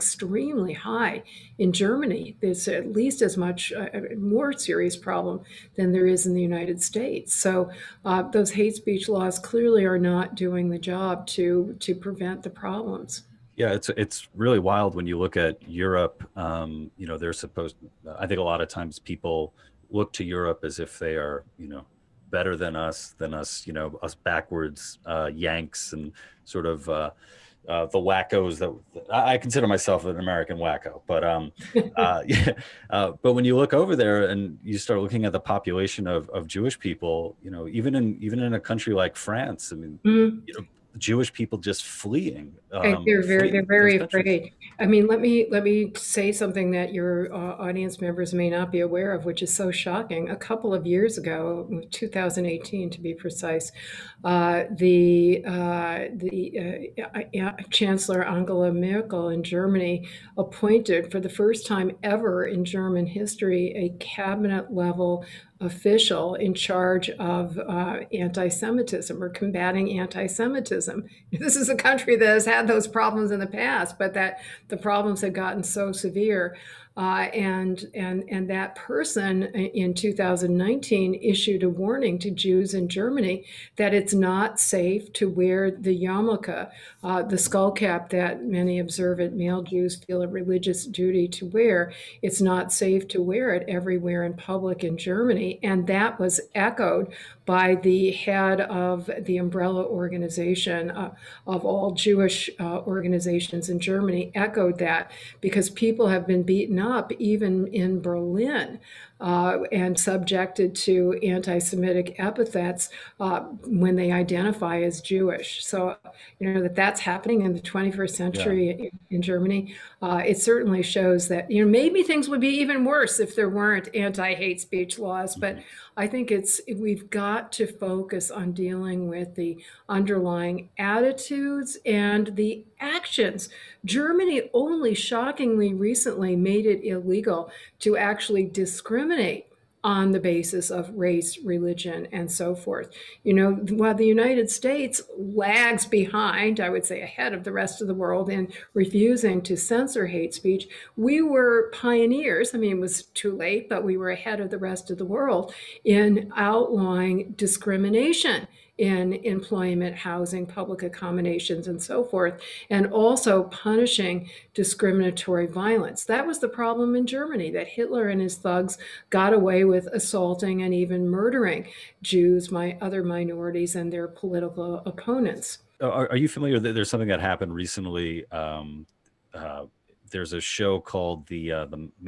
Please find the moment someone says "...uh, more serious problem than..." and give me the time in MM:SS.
00:03.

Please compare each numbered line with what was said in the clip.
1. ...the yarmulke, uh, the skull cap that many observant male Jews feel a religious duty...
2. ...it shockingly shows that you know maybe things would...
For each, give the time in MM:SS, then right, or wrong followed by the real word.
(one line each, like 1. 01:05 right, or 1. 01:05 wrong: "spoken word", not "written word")
1. 01:25 right
2. 02:00 wrong: "certainly", not "shockingly".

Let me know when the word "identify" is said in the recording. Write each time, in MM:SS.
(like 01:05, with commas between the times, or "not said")
01:54.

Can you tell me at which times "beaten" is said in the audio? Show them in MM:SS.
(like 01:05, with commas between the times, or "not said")
01:46.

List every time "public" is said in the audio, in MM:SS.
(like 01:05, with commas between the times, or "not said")
01:34, 02:40.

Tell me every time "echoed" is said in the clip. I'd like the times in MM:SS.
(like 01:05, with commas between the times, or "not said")
01:36, 01:44.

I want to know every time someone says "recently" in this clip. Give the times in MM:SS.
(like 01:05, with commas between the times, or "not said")
02:15, 02:57.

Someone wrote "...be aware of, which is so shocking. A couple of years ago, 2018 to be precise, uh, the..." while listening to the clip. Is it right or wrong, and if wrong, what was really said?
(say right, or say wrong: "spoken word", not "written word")
right.